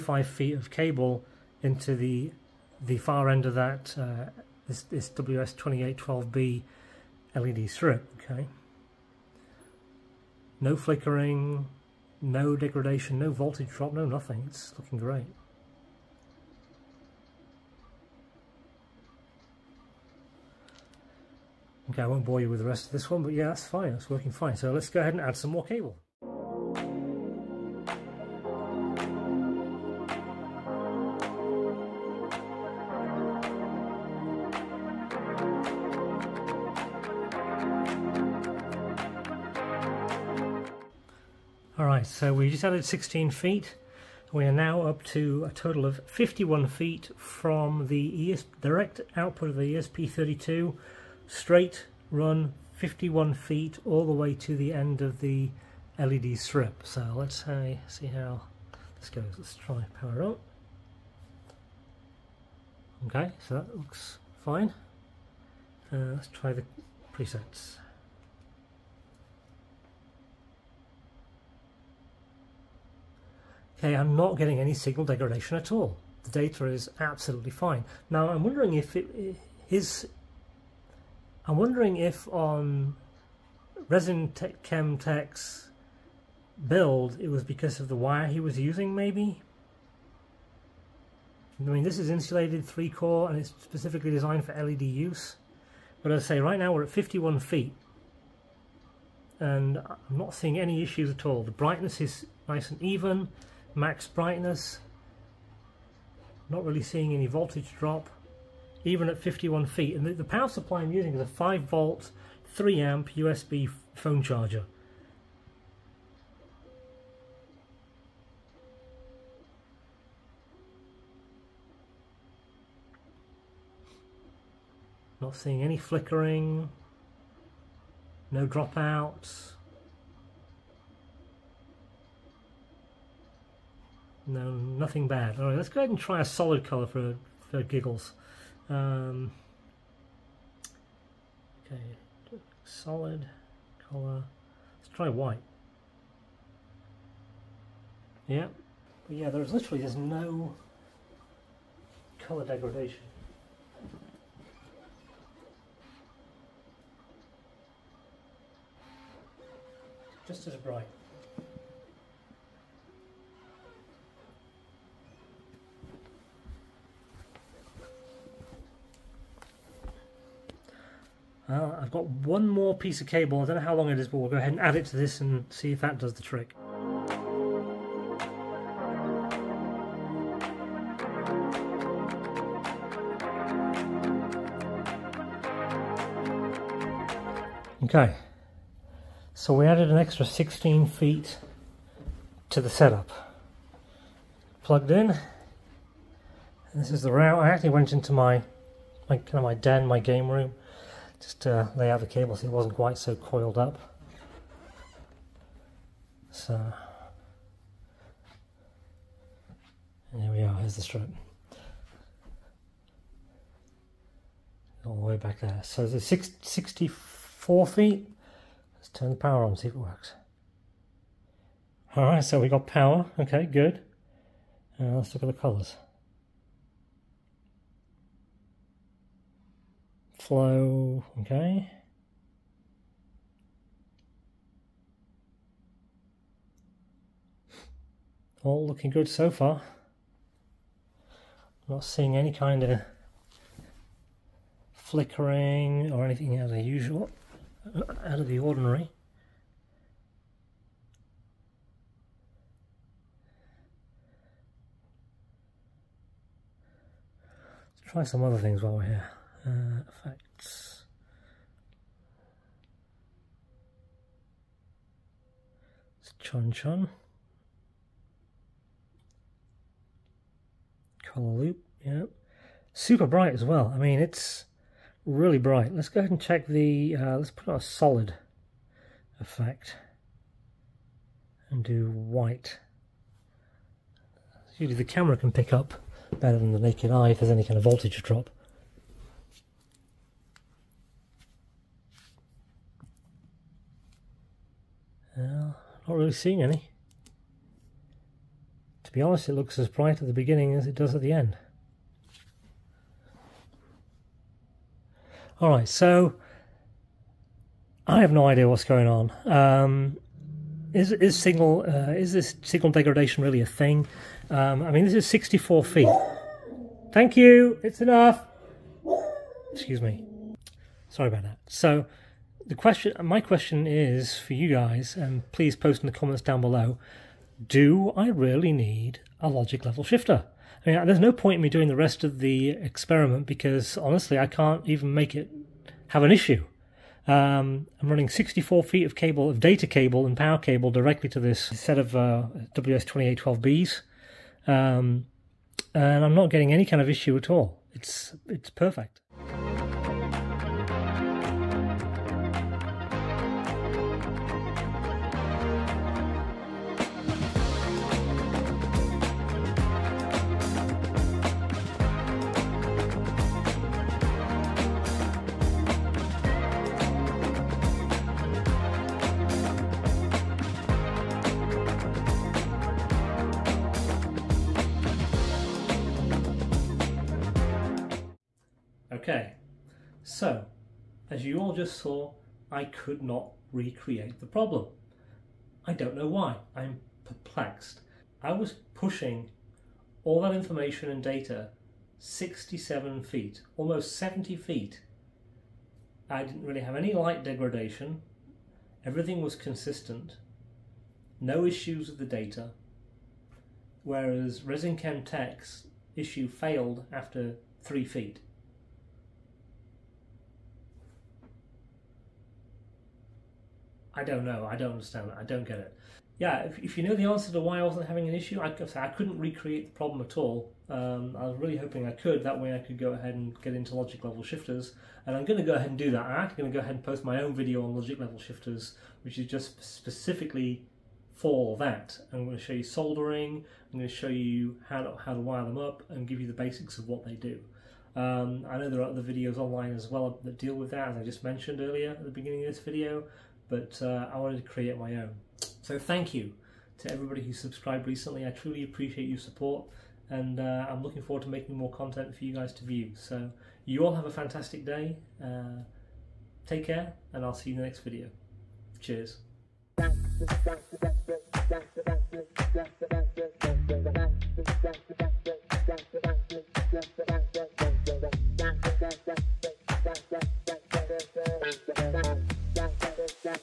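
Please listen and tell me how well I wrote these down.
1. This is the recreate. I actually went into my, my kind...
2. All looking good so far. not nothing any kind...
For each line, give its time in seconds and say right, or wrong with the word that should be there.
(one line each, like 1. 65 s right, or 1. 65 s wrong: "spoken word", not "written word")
1. 196 s wrong: "route", not "recreate"
2. 238 s wrong: "seeing", not "nothing".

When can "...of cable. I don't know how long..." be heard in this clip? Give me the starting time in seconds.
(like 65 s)
173 s.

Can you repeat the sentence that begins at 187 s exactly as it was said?
Okay, so we added an extra 16 feet to the setup.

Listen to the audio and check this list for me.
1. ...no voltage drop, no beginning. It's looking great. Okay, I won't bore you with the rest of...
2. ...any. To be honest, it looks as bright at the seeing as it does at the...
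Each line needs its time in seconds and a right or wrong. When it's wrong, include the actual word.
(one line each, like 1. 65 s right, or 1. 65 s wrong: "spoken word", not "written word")
1. 13 s wrong: "nothing", not "beginning"
2. 296 s wrong: "beginning", not "seeing".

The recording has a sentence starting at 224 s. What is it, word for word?
Uh, let's look at the colours.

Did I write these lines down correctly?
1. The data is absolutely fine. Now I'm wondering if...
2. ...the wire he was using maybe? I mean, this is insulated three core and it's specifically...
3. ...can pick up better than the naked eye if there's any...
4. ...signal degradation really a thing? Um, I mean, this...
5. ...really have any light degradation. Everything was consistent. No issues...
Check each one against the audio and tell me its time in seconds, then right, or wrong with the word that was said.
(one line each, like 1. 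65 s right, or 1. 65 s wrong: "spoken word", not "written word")
1. 76 s right
2. 87 s right
3. 285 s right
4. 312 s right
5. 396 s right.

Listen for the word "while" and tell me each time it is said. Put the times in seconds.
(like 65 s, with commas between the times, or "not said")
258 s.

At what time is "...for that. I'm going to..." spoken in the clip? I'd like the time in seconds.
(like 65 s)
431 s.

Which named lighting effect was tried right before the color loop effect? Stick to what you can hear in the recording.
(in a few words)
Chunchun.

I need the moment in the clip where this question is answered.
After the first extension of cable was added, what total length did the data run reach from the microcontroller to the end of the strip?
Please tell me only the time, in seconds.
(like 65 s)
45 s.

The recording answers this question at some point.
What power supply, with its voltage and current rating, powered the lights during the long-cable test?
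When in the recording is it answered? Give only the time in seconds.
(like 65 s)
111 s.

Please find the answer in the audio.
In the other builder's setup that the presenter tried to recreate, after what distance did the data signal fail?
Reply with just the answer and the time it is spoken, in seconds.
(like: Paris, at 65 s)
3 feet, at 407 s.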